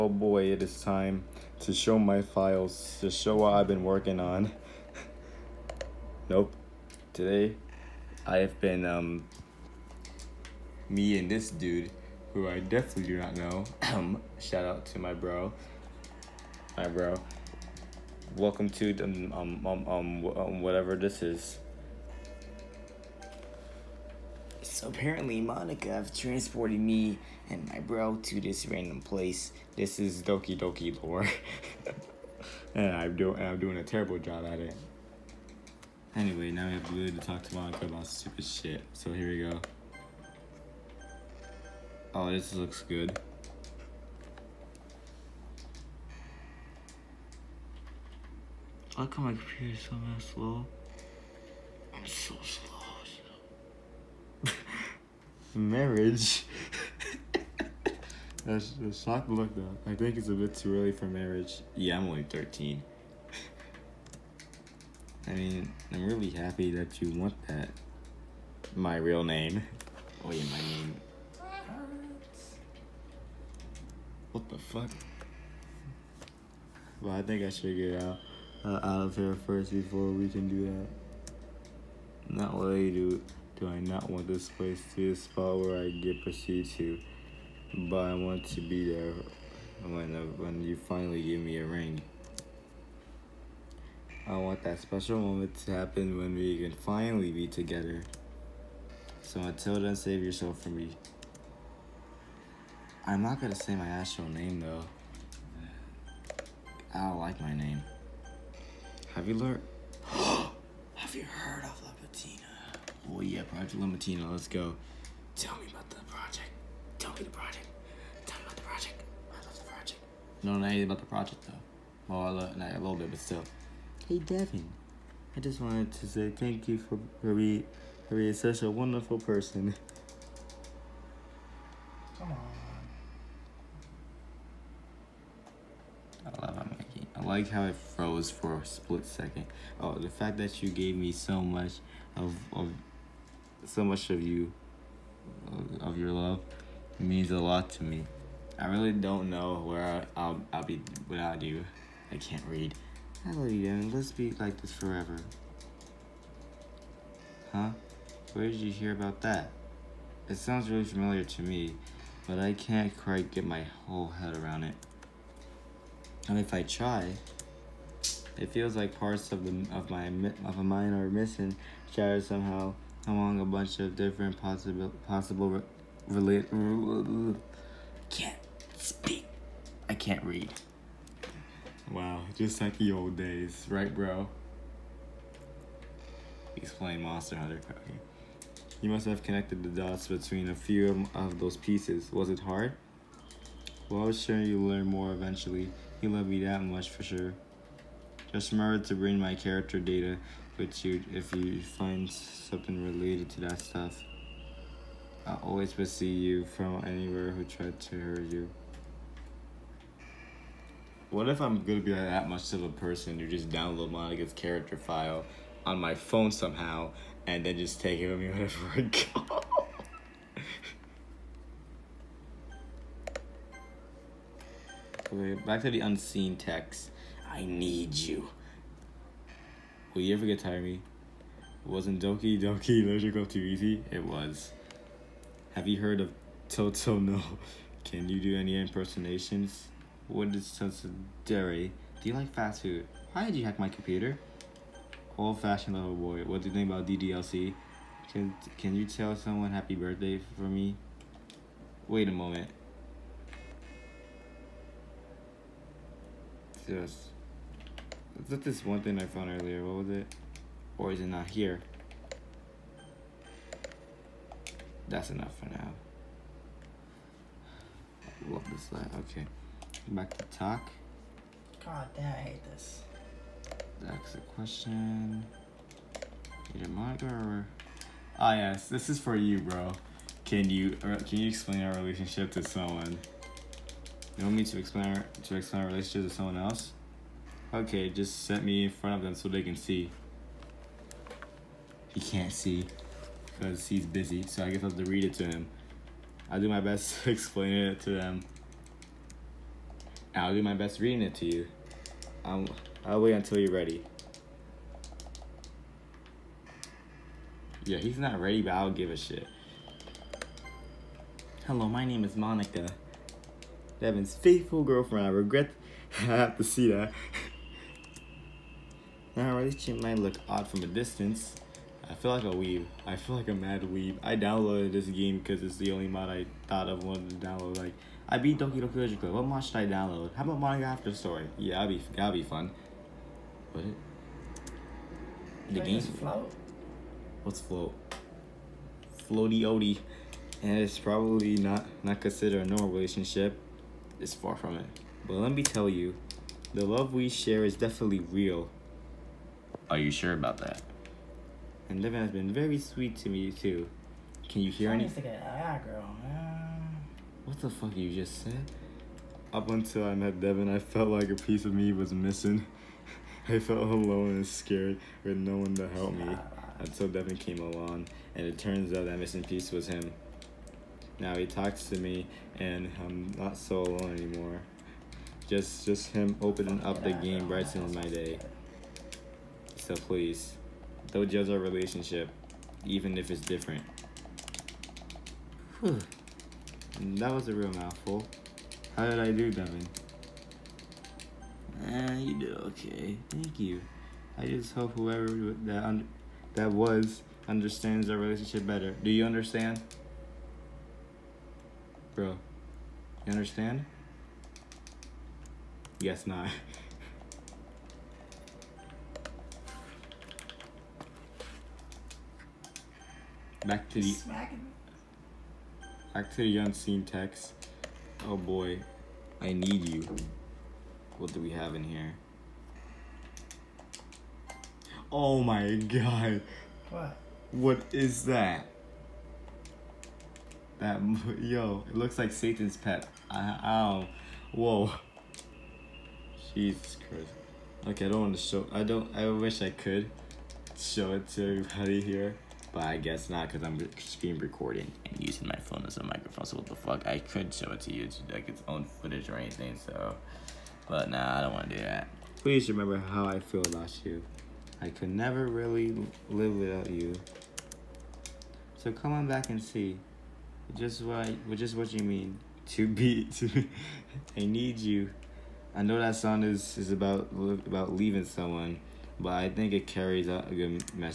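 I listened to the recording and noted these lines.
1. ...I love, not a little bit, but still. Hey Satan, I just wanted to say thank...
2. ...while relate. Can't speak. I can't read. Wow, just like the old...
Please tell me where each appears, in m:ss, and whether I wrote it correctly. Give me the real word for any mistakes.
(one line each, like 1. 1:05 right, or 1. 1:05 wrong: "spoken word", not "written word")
1. 2:02 wrong: "Devin", not "Satan"
2. 2:55 wrong: "possible", not "while".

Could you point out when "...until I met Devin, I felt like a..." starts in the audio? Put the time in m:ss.
5:59.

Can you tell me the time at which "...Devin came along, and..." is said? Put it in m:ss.
6:06.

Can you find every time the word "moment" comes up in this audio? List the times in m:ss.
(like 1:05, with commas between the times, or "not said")
1:35, 4:12.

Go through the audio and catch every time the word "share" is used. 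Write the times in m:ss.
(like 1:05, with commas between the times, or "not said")
5:47.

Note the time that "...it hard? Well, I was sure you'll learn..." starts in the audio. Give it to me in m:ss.
3:12.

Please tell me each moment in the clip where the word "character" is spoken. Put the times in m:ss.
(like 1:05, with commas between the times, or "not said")
3:19, 3:34.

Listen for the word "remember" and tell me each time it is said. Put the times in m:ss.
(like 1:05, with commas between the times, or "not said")
3:18, 7:32.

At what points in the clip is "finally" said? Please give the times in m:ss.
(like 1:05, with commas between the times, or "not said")
1:30, 1:36.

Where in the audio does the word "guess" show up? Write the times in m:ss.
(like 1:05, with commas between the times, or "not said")
4:54, 7:22.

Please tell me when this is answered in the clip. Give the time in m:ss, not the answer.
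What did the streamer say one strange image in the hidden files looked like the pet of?
7:12.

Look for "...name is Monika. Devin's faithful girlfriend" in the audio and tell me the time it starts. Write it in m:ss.
5:11.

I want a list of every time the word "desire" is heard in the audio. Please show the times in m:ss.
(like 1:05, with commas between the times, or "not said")
not said.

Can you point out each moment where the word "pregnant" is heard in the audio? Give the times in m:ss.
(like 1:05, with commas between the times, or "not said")
not said.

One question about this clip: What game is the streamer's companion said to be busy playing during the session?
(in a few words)
Monster Hunter.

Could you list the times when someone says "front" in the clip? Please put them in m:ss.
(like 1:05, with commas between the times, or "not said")
4:48.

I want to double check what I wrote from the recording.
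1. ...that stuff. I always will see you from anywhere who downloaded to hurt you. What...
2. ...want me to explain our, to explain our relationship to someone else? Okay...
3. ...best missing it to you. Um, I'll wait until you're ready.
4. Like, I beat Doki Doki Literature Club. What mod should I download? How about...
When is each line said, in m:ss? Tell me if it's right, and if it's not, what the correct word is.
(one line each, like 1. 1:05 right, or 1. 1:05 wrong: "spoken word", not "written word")
1. 3:23 wrong: "tried", not "downloaded"
2. 4:44 right
3. 5:00 wrong: "reading", not "missing"
4. 5:27 right.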